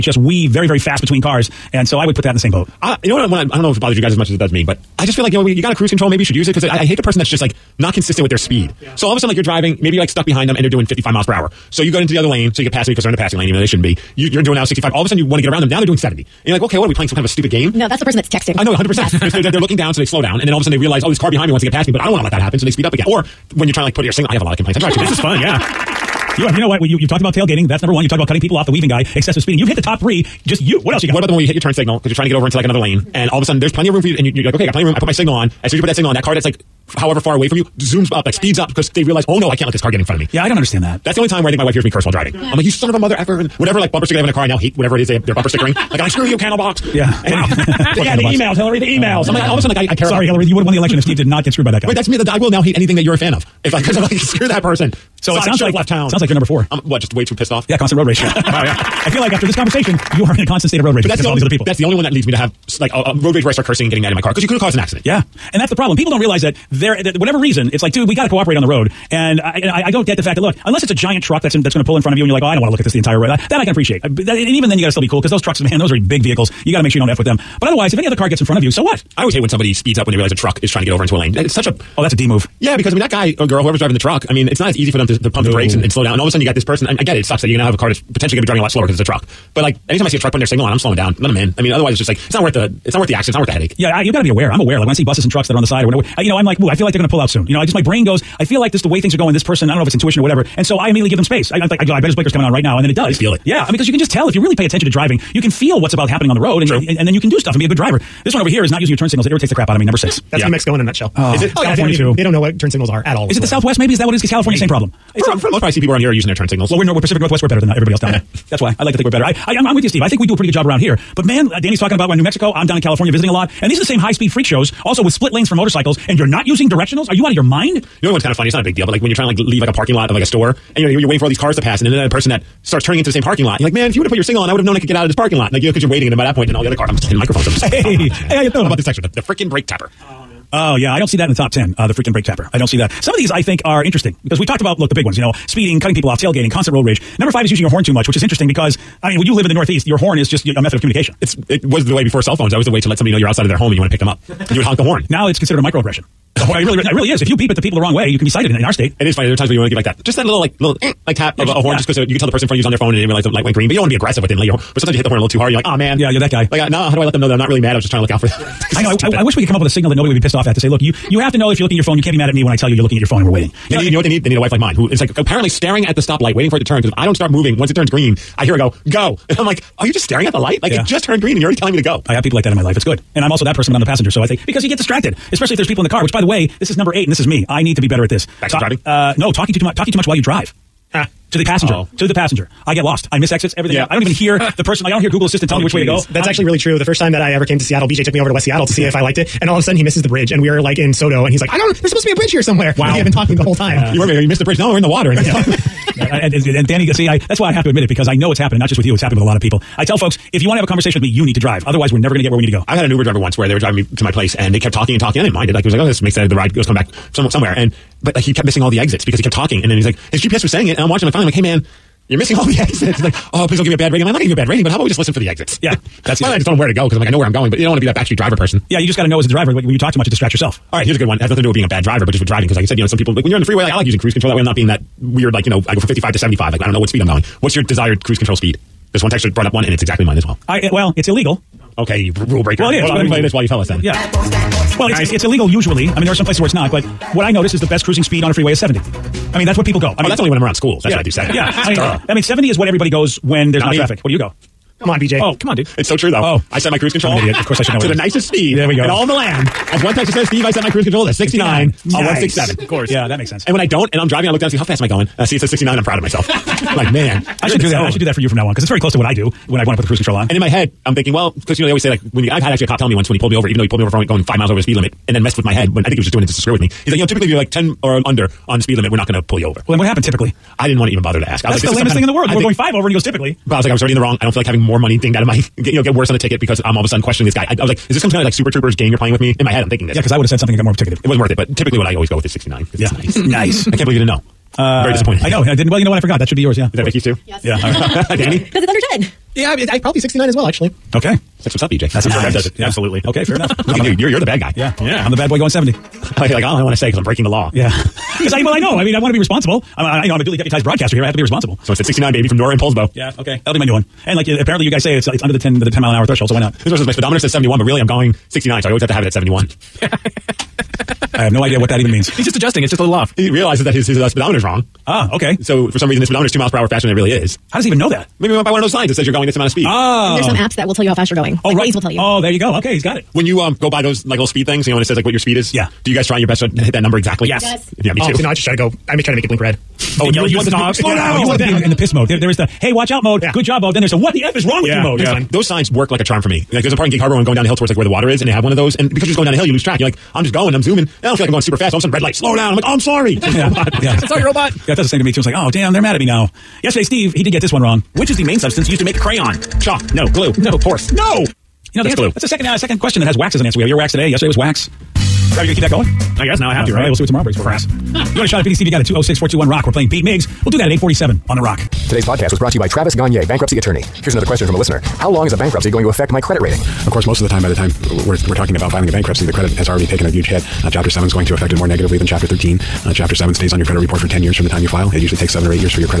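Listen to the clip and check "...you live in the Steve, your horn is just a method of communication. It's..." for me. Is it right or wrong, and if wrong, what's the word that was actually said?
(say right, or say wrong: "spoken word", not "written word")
wrong: "Northeast", not "Steve".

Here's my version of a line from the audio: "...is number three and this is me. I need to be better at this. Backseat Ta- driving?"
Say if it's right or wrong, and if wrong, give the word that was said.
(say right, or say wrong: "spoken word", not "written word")
wrong: "eight", not "three".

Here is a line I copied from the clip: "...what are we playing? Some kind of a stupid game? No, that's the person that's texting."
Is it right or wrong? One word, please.
right.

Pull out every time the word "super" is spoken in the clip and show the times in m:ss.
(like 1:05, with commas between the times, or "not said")
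4:48, 5:51.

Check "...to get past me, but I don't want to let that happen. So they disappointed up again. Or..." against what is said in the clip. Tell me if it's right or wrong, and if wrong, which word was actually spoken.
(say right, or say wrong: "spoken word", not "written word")
wrong: "speed", not "disappointed".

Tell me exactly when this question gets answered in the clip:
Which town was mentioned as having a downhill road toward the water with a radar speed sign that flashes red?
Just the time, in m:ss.
5:46.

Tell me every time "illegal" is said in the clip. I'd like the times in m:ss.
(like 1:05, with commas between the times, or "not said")
4:01, 4:05.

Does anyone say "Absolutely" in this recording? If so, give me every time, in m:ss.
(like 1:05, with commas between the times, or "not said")
5:02.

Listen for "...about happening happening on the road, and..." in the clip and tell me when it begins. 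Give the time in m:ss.
1:45.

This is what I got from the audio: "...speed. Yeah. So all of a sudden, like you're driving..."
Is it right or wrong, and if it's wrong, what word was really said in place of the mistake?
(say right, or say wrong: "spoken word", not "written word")
right.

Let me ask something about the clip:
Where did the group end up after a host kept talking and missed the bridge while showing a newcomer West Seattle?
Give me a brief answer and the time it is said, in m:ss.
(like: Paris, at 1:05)
SoDo, at 3:20.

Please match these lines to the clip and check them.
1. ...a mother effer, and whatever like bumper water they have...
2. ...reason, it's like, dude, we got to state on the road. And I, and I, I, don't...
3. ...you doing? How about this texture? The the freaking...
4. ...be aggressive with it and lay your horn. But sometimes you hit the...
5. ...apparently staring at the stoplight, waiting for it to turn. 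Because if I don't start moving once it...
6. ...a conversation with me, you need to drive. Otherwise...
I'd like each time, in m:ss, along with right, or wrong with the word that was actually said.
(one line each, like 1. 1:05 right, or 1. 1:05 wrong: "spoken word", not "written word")
1. 0:42 wrong: "sticker", not "water"
2. 1:07 wrong: "cooperate", not "state"
3. 2:18 right
4. 2:43 right
5. 2:55 right
6. 3:30 right.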